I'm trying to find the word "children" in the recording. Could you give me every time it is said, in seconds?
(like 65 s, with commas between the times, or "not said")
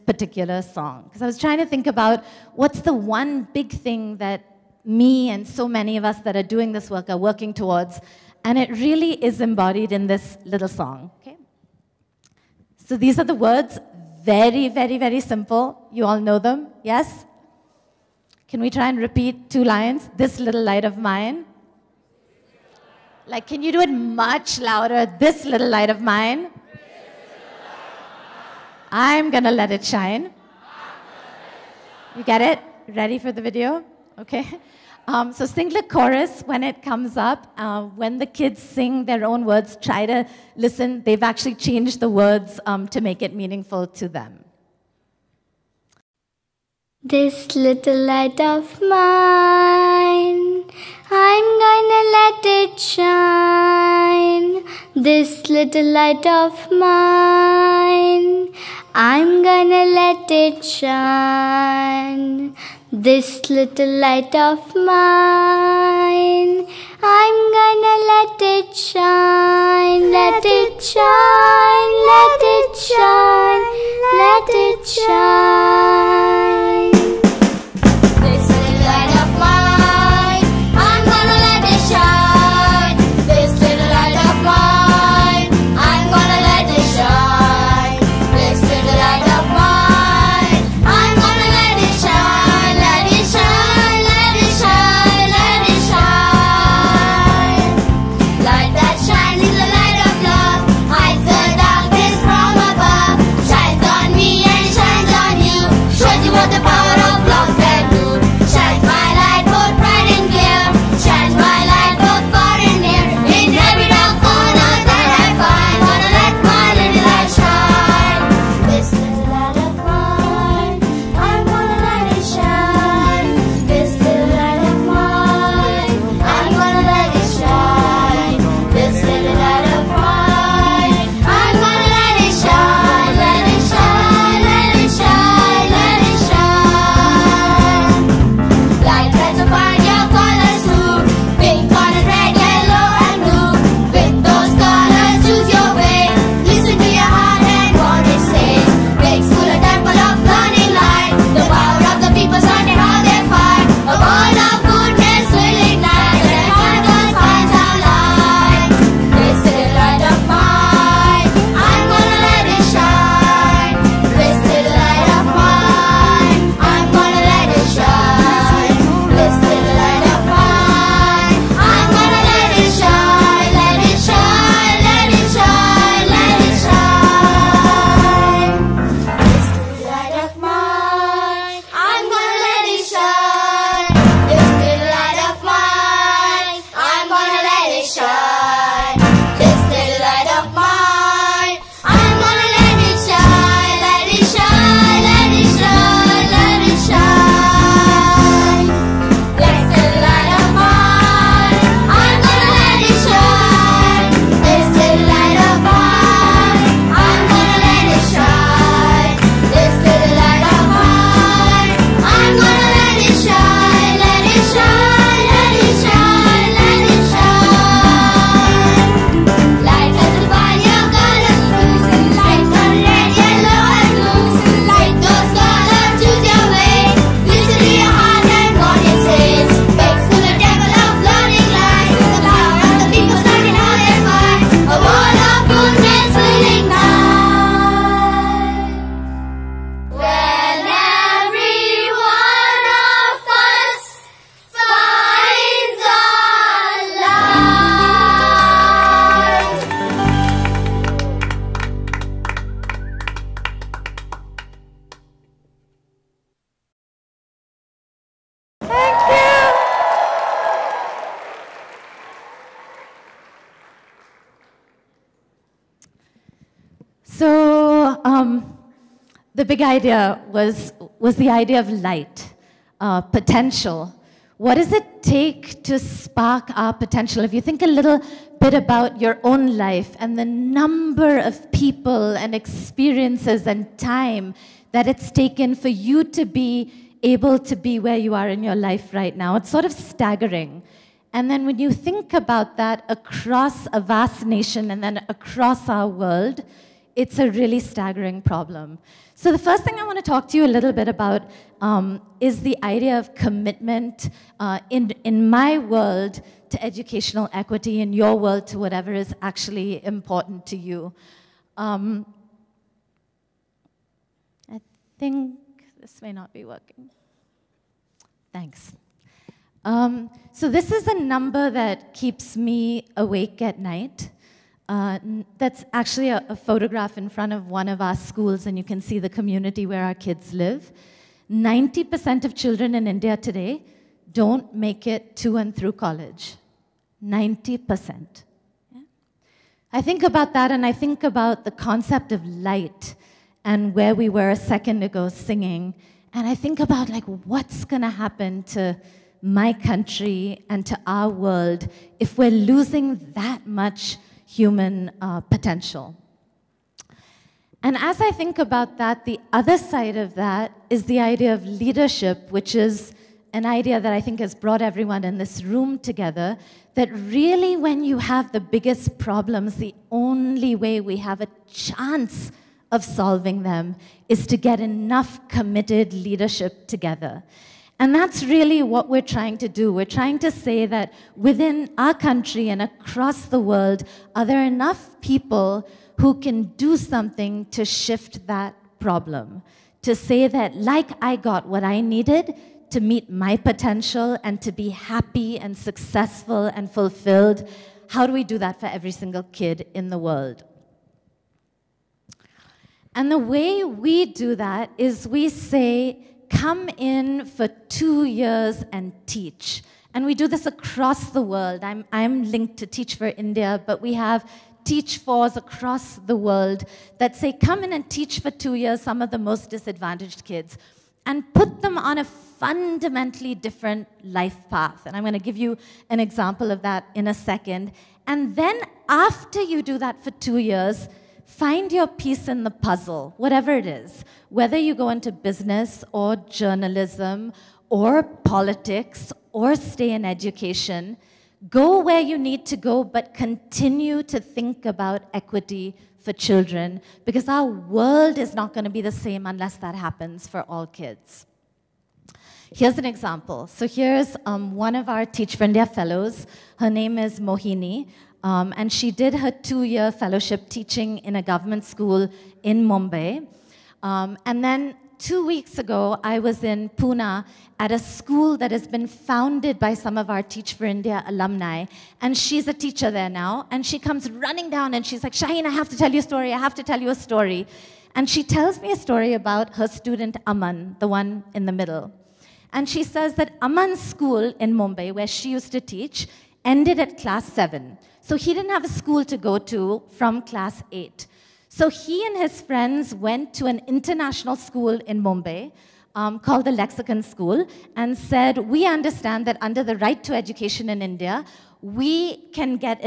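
332 s, 446 s.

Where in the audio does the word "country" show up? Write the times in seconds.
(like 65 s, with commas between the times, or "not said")
349 s, 381 s.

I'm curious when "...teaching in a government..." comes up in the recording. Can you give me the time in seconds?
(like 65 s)
460 s.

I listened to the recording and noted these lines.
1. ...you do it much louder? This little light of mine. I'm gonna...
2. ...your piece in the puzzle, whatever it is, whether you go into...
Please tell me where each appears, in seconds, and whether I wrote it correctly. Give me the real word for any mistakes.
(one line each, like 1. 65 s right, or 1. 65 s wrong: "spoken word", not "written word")
1. 23 s right
2. 431 s right.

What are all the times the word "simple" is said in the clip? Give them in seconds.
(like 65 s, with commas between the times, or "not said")
15 s.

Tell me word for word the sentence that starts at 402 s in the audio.
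And the way we do that is we say, come in for two years and teach.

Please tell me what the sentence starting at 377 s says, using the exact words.
And that's really what we're trying to do.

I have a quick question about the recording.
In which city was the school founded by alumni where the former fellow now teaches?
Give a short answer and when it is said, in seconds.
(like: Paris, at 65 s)
Pune, at 466 s.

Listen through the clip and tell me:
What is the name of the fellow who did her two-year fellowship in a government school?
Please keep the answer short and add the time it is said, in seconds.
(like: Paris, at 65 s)
Mohini, at 457 s.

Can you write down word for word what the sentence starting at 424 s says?
And I'm going to give you an example of that in a second.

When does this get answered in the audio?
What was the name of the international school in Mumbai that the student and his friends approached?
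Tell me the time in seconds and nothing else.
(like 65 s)
496 s.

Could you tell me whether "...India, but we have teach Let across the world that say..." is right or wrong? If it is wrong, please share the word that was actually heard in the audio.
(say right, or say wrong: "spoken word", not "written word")
wrong: "Fours", not "Let".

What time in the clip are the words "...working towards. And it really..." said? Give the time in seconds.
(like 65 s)
7 s.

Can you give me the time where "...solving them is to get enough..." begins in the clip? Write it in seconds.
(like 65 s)
372 s.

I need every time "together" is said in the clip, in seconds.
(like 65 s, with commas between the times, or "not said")
365 s, 376 s.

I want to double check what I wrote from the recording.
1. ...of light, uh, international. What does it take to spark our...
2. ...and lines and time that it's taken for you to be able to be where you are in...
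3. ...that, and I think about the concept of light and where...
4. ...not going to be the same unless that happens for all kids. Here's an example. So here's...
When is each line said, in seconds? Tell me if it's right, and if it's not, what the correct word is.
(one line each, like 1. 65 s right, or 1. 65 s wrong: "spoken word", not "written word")
1. 271 s wrong: "potential", not "international"
2. 282 s wrong: "experiences", not "lines"
3. 340 s right
4. 448 s right.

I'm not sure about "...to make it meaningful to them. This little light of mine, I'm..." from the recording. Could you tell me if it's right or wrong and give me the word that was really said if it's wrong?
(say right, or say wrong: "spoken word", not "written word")
right.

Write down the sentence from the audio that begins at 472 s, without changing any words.
And she's a teacher there now.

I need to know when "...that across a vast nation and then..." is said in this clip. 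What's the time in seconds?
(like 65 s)
292 s.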